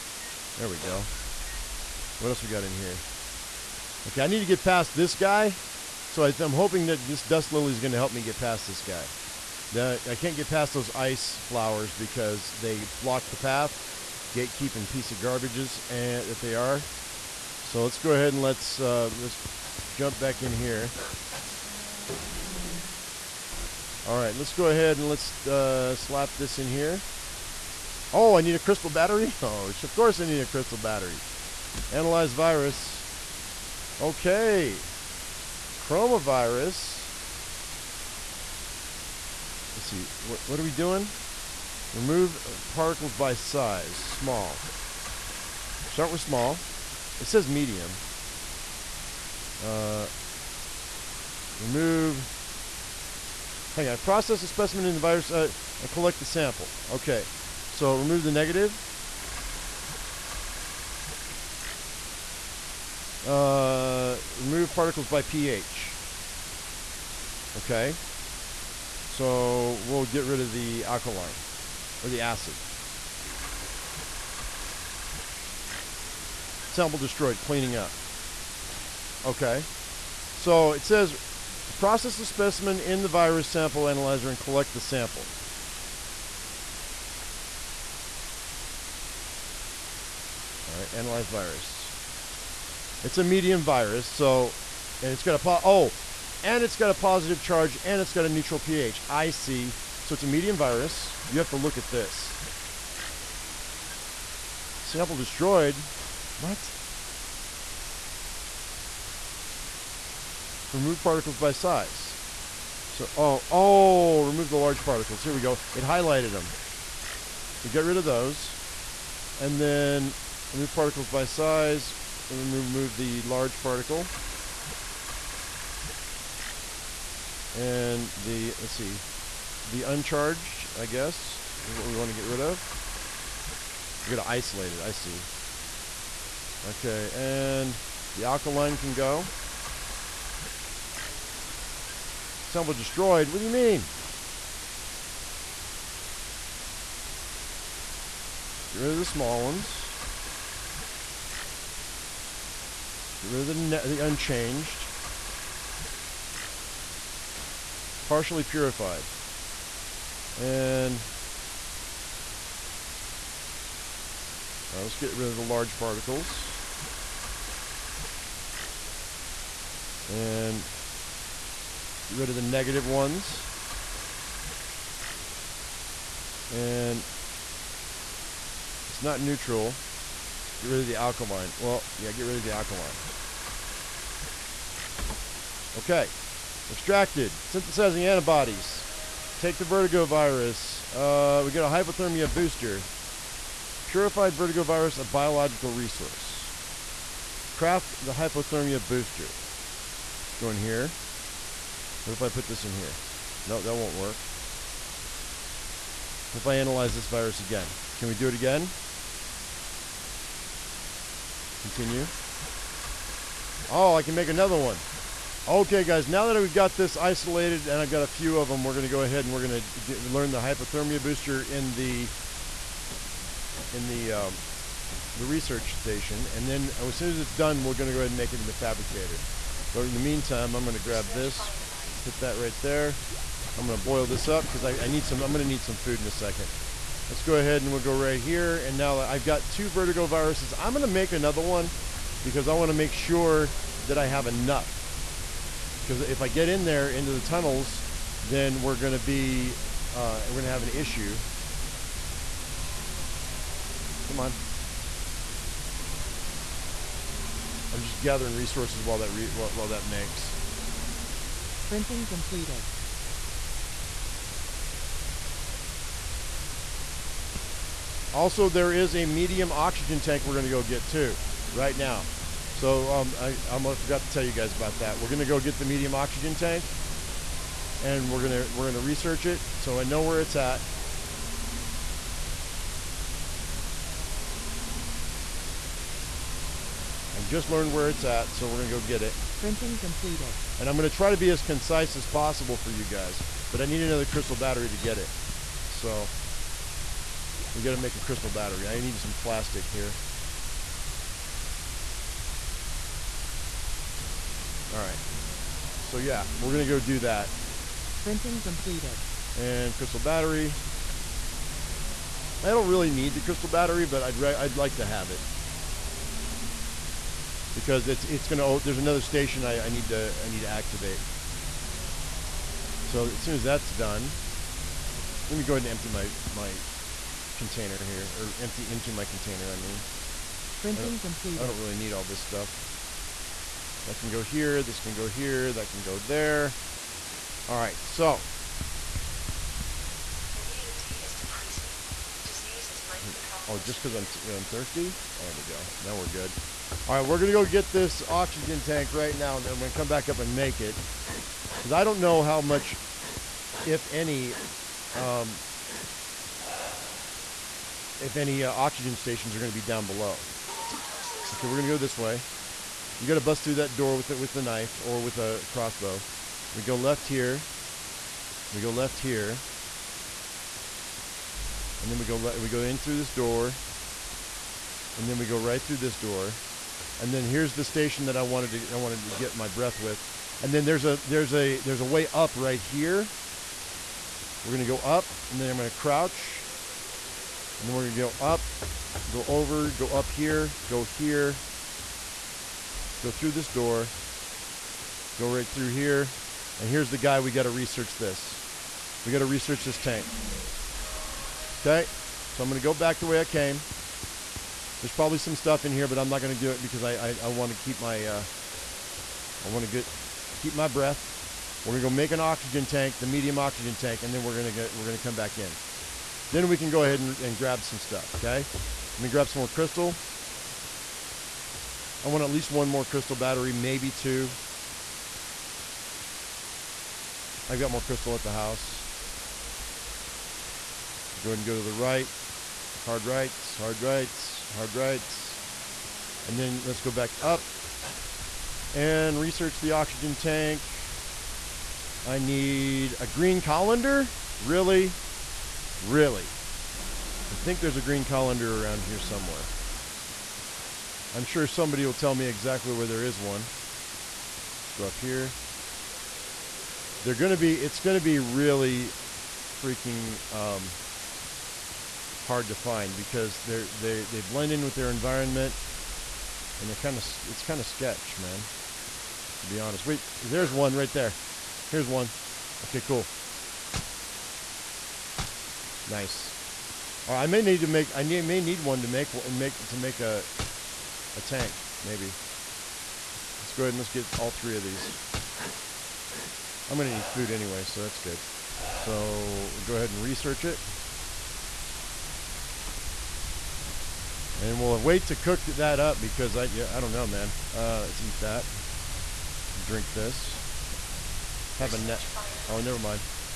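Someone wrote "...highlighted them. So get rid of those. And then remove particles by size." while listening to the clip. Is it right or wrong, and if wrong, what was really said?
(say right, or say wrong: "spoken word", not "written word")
right.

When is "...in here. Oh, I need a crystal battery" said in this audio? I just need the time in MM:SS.
00:26.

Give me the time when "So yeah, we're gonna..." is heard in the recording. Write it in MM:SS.
05:05.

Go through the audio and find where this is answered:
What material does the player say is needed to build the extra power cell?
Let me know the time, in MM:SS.
04:59.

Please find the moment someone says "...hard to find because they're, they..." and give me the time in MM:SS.
07:42.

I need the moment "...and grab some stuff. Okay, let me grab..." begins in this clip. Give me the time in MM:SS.
06:57.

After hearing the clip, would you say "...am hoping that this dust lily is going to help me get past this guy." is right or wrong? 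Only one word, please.
right.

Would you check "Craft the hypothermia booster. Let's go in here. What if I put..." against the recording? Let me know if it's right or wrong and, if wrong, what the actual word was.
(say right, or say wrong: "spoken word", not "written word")
right.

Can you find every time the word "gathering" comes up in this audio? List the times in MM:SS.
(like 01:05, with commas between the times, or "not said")
04:18.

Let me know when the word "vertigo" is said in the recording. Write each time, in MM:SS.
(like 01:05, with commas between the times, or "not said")
03:09, 03:14, 03:59.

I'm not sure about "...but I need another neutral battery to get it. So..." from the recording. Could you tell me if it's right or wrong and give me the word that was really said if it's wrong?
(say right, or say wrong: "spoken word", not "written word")
wrong: "crystal", not "neutral".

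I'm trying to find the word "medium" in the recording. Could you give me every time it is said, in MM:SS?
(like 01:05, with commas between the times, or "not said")
00:47, 01:33, 01:40, 04:29, 04:35, 06:53.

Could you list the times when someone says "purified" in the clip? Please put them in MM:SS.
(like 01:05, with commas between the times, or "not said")
02:38, 03:13.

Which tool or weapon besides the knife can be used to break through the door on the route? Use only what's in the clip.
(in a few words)
crossbow.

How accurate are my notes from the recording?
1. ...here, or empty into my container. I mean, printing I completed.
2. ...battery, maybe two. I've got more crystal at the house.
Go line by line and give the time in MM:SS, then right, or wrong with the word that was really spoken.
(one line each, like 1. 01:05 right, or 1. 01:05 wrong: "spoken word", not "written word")
1. 05:27 right
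2. 07:03 right.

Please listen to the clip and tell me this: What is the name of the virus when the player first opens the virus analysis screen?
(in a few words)
Chromavirus.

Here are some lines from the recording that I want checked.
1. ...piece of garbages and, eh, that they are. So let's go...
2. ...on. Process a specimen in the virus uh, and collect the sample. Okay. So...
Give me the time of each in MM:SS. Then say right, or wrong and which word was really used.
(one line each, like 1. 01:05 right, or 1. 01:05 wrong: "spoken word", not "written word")
1. 00:14 right
2. 00:53 right.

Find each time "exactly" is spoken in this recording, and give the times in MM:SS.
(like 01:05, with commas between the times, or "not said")
07:32.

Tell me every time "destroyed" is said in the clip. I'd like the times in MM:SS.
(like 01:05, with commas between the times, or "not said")
01:16, 01:45, 02:22.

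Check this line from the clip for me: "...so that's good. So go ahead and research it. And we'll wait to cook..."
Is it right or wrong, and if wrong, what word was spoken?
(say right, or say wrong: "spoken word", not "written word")
right.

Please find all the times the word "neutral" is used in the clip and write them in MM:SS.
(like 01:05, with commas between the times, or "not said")
01:38, 02:59.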